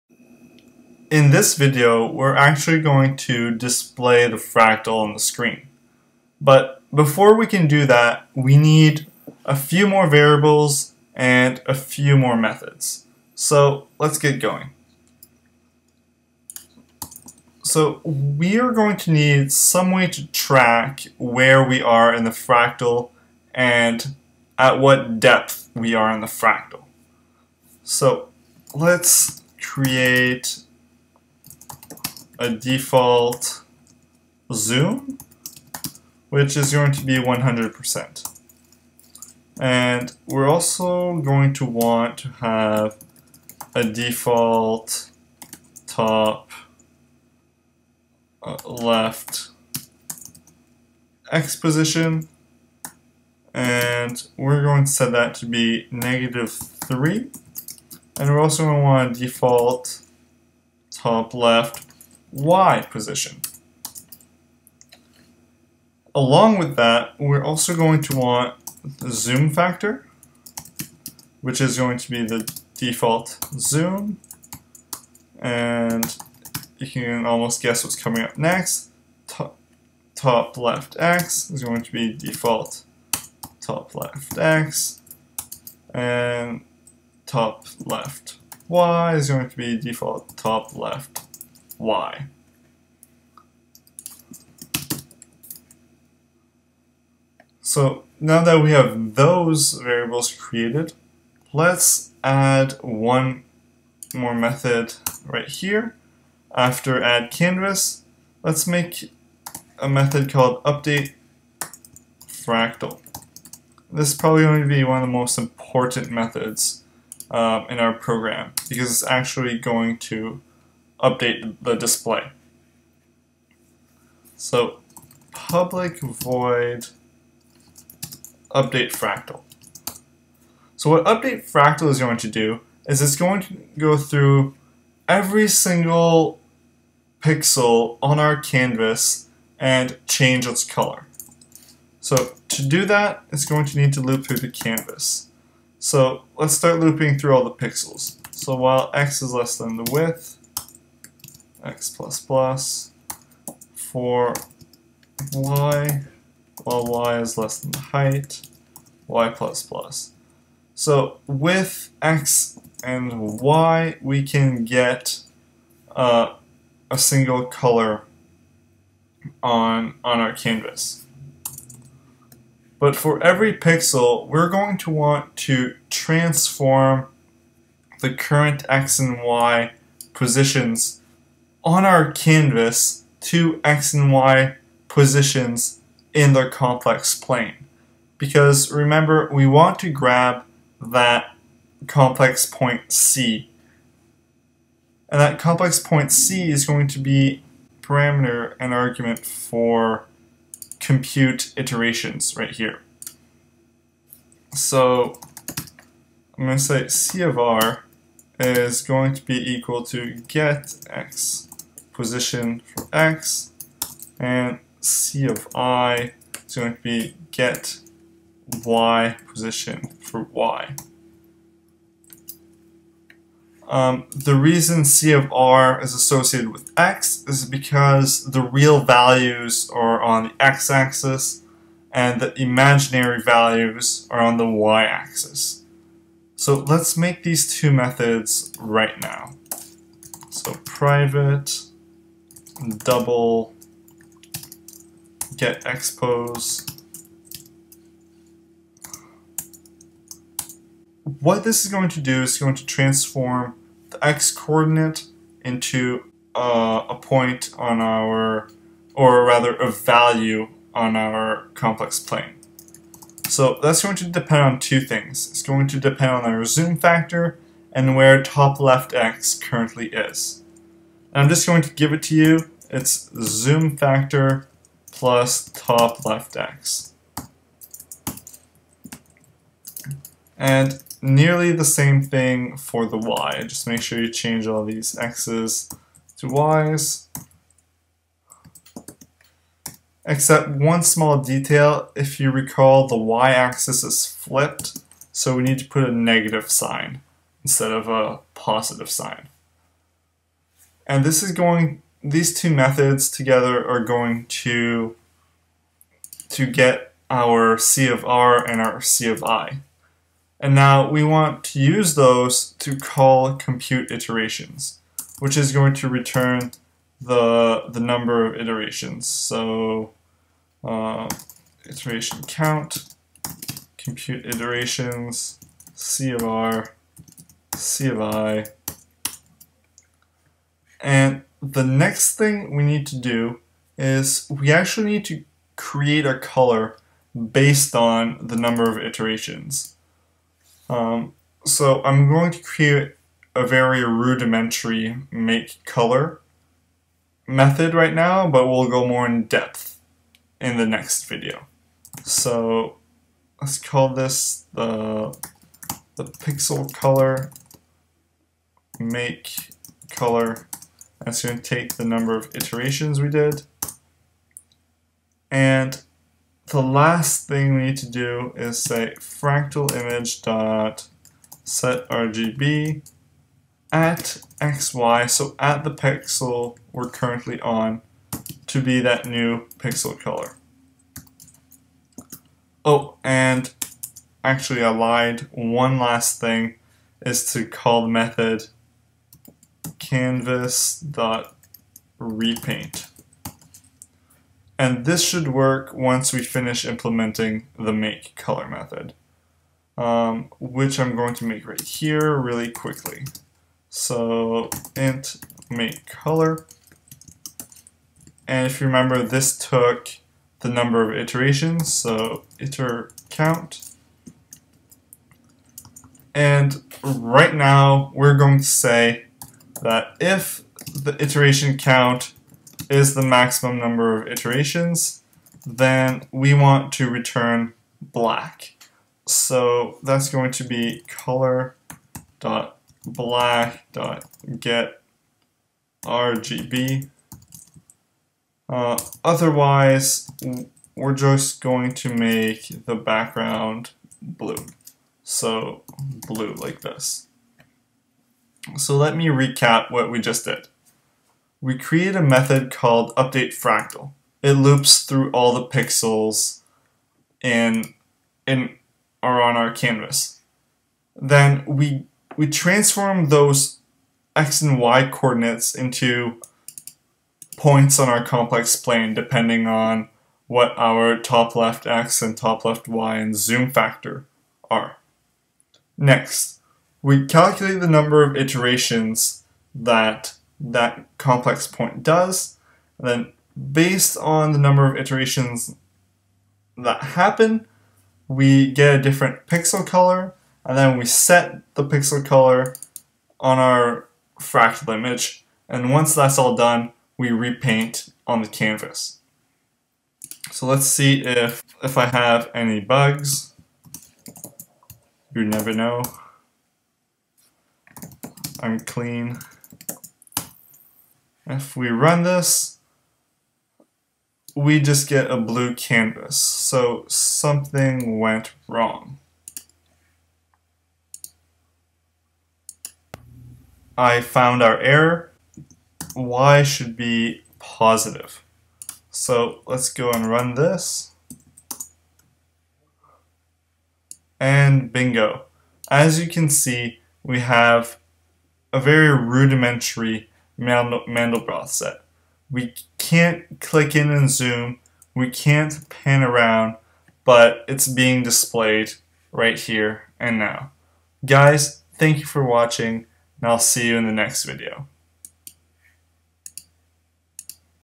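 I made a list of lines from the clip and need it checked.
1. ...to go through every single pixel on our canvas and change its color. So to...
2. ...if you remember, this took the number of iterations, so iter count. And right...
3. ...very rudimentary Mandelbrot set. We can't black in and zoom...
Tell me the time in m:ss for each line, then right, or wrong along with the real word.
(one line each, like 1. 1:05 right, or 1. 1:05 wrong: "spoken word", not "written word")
1. 2:13 right
2. 6:48 right
3. 8:58 wrong: "click", not "black".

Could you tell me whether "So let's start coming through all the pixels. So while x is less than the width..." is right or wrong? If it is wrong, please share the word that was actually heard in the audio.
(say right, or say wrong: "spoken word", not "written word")
wrong: "looping", not "coming".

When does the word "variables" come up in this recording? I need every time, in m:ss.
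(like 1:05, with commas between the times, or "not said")
0:10, 1:39.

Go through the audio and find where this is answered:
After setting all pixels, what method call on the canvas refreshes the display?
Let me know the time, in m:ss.
6:29.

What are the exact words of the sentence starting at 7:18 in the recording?
Uh, otherwise, we're just going to make the background blue.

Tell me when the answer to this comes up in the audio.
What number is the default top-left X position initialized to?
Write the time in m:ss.
0:55.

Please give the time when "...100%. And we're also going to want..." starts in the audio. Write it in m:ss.
0:37.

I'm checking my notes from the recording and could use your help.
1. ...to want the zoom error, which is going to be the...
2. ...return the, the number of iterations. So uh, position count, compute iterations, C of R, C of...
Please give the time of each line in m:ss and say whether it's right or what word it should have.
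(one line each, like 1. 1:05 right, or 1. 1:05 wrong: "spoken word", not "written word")
1. 1:08 wrong: "factor", not "error"
2. 5:15 wrong: "iteration", not "position".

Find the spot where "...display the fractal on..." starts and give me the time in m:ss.
0:03.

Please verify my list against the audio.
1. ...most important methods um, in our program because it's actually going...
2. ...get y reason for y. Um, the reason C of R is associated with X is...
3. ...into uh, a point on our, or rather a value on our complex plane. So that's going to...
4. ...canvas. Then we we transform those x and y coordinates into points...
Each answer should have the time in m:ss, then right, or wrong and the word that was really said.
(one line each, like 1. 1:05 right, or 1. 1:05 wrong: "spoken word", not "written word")
1. 1:55 right
2. 3:37 wrong: "position", not "reason"
3. 4:15 right
4. 7:39 right.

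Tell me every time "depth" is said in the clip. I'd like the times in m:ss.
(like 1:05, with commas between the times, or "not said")
0:25, 5:49.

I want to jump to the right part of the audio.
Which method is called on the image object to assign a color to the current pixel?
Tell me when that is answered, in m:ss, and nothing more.
6:11.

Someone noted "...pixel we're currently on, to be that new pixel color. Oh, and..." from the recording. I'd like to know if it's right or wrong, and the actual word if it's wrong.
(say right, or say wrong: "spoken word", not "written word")
right.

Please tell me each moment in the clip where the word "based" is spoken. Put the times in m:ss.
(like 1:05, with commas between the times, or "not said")
5:37, 8:03.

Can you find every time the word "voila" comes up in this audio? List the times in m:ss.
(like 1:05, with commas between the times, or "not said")
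not said.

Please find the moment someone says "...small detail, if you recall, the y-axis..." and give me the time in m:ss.
4:50.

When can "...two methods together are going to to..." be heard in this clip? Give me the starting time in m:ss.
5:02.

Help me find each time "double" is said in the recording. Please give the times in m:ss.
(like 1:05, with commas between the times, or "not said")
4:02.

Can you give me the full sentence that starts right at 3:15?
And that complex point C is going to be parameter and argument for compute iterations right here.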